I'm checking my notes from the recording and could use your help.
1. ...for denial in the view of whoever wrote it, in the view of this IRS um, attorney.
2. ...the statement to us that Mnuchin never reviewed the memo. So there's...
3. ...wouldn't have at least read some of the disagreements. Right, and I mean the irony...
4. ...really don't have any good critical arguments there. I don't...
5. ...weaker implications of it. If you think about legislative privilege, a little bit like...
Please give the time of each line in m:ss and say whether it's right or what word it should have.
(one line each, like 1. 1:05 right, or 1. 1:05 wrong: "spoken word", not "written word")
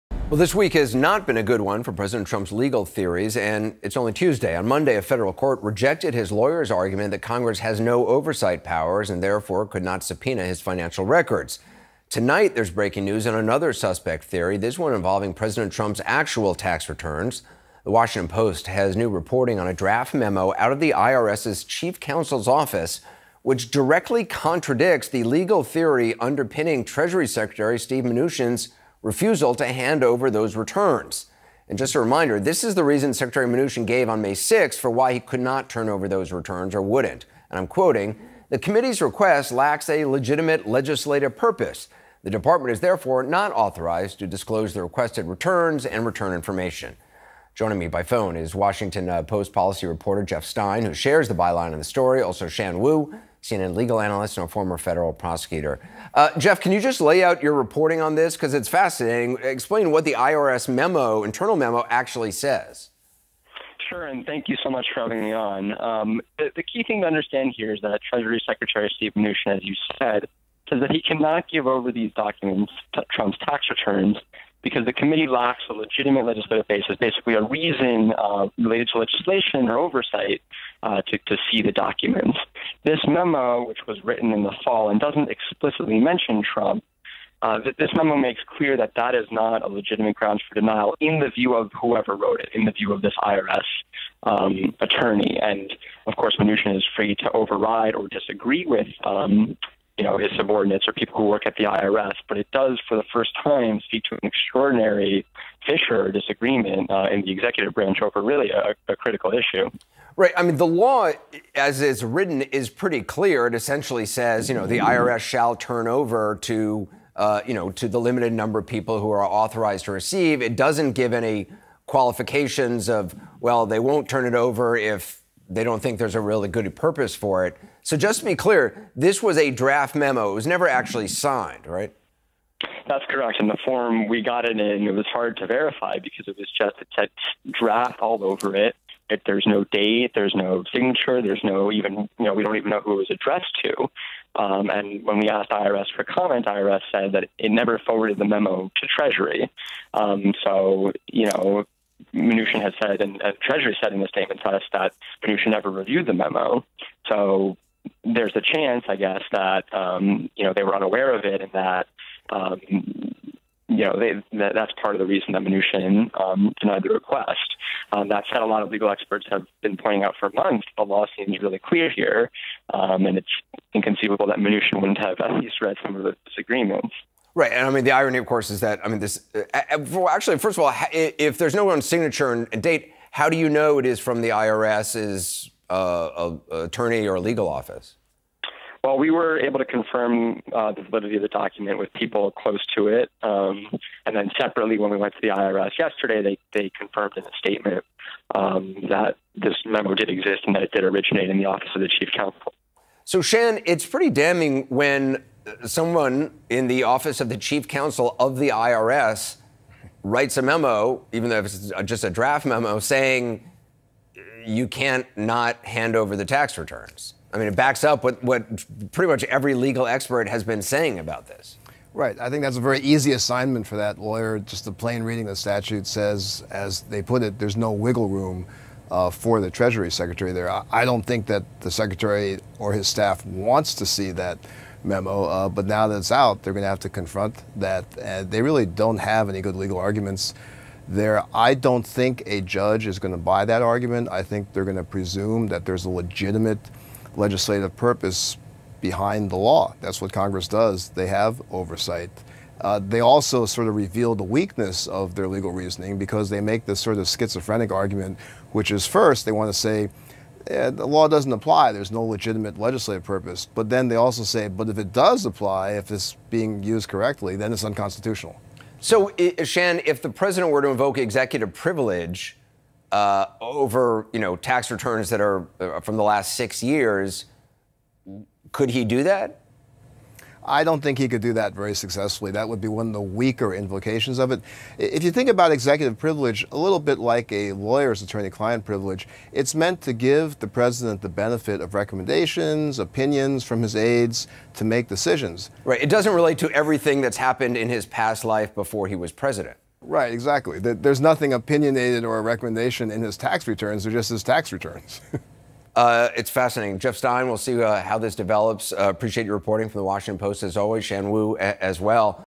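1. 1:30 right
2. 2:34 right
3. 2:54 right
4. 3:58 wrong: "legal", not "critical"
5. 4:43 wrong: "executive", not "legislative".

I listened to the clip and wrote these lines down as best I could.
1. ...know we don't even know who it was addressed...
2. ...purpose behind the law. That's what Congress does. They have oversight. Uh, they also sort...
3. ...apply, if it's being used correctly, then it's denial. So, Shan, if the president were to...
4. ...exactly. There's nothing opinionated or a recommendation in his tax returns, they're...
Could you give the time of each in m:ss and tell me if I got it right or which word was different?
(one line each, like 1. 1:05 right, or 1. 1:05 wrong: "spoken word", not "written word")
1. 2:22 right
2. 4:07 right
3. 4:25 wrong: "unconstitutional", not "denial"
4. 5:00 right.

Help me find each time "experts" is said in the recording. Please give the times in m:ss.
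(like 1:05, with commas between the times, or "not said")
2:48, 3:39.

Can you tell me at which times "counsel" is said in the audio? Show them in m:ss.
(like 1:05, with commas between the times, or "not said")
0:21, 3:22, 3:27.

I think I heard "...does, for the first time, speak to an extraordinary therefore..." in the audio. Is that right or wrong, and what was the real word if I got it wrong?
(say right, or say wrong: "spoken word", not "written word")
wrong: "fissure", not "therefore".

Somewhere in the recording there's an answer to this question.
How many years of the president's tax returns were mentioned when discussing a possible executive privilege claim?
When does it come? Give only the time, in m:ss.
4:36.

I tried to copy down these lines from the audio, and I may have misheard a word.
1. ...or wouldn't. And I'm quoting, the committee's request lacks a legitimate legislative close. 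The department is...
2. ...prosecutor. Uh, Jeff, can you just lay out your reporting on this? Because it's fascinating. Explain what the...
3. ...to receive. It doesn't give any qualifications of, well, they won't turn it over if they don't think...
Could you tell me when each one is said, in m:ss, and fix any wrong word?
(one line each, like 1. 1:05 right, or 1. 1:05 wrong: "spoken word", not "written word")
1. 0:36 wrong: "purpose", not "close"
2. 0:55 right
3. 1:59 right.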